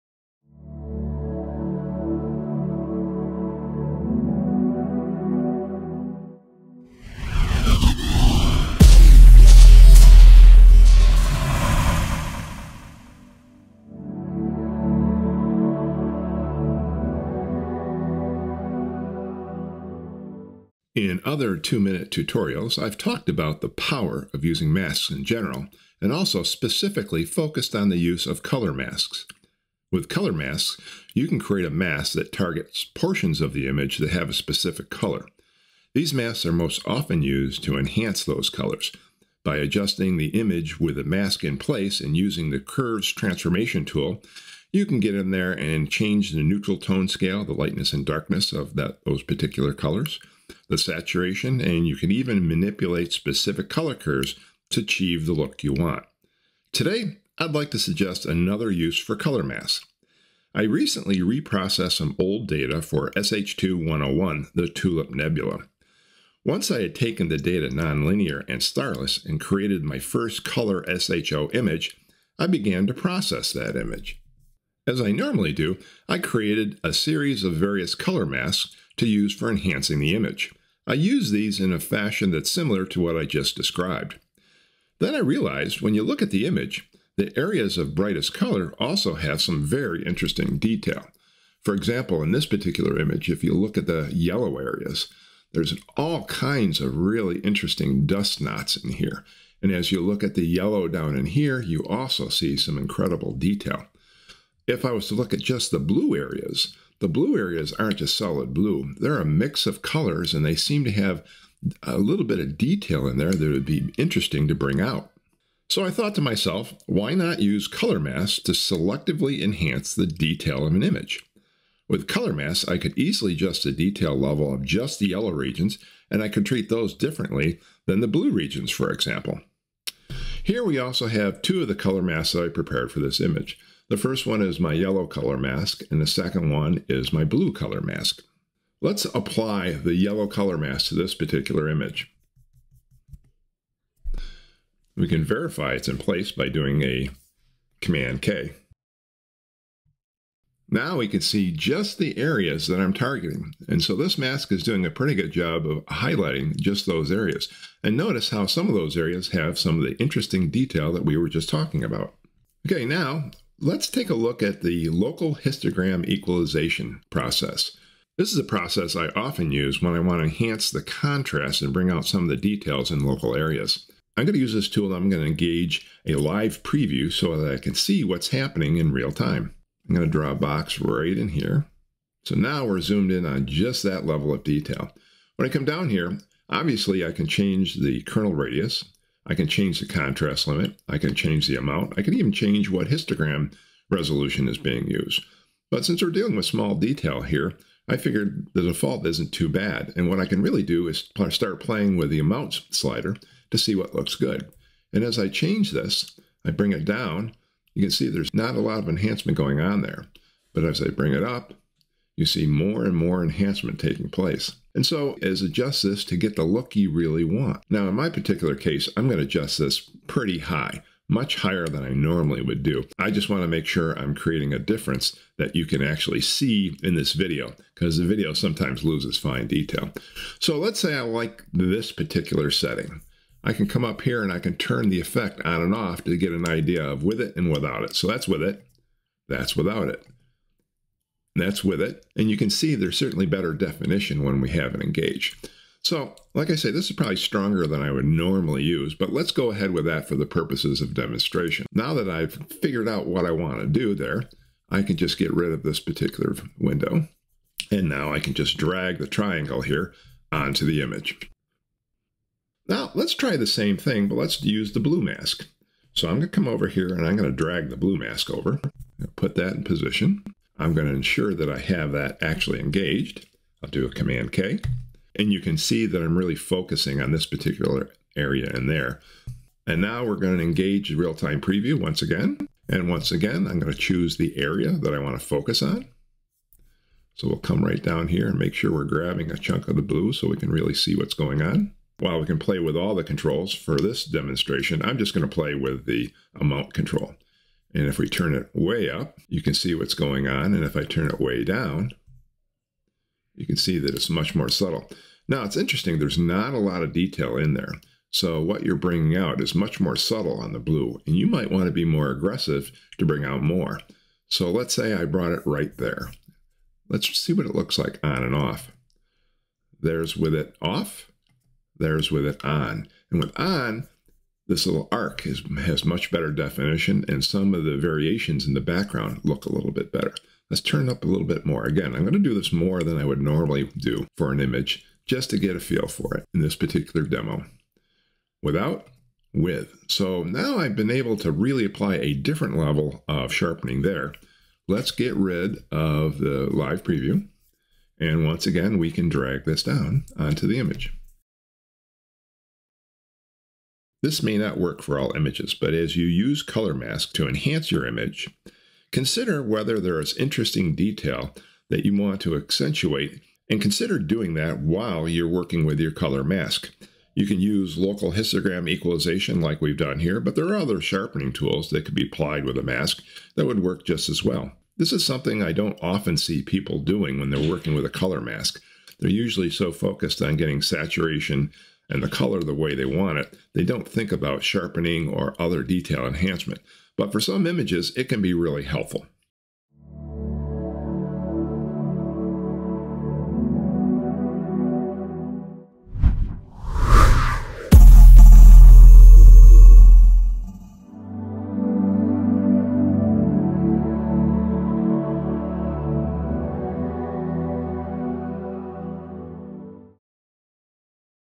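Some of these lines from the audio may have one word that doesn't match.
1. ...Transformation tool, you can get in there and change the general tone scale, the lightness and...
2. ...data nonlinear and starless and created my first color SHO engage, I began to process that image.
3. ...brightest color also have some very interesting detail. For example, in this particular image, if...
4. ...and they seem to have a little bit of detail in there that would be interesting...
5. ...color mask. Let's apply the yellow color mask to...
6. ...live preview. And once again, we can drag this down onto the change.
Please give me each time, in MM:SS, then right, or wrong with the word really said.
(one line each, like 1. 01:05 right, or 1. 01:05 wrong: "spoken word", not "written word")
1. 00:43 wrong: "neutral", not "general"
2. 01:07 wrong: "image", not "engage"
3. 01:27 right
4. 01:50 right
5. 02:17 right
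6. 05:46 wrong: "image", not "change".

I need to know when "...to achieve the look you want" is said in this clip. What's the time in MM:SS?
00:54.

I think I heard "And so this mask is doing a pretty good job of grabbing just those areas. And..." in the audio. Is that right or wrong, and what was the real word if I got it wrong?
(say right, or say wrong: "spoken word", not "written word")
wrong: "highlighting", not "grabbing".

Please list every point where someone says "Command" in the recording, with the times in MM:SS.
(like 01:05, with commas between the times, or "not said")
02:27, 04:33.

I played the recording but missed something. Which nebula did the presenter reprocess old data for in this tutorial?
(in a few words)
SH2-101, the Tulip Nebula.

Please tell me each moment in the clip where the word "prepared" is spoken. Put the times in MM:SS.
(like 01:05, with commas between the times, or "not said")
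02:12.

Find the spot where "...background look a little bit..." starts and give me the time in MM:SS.
05:28.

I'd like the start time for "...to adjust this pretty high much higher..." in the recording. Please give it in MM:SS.
03:39.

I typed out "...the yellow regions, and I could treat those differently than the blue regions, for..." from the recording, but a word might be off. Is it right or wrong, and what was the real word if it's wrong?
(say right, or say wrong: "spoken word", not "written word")
right.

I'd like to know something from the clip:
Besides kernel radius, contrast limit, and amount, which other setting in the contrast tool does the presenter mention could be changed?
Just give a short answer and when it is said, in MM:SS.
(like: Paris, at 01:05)
Histogram resolution, at 03:12.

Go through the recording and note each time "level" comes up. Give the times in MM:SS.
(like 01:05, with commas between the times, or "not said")
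02:04, 03:04, 05:42.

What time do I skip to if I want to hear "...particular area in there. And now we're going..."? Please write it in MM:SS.
04:37.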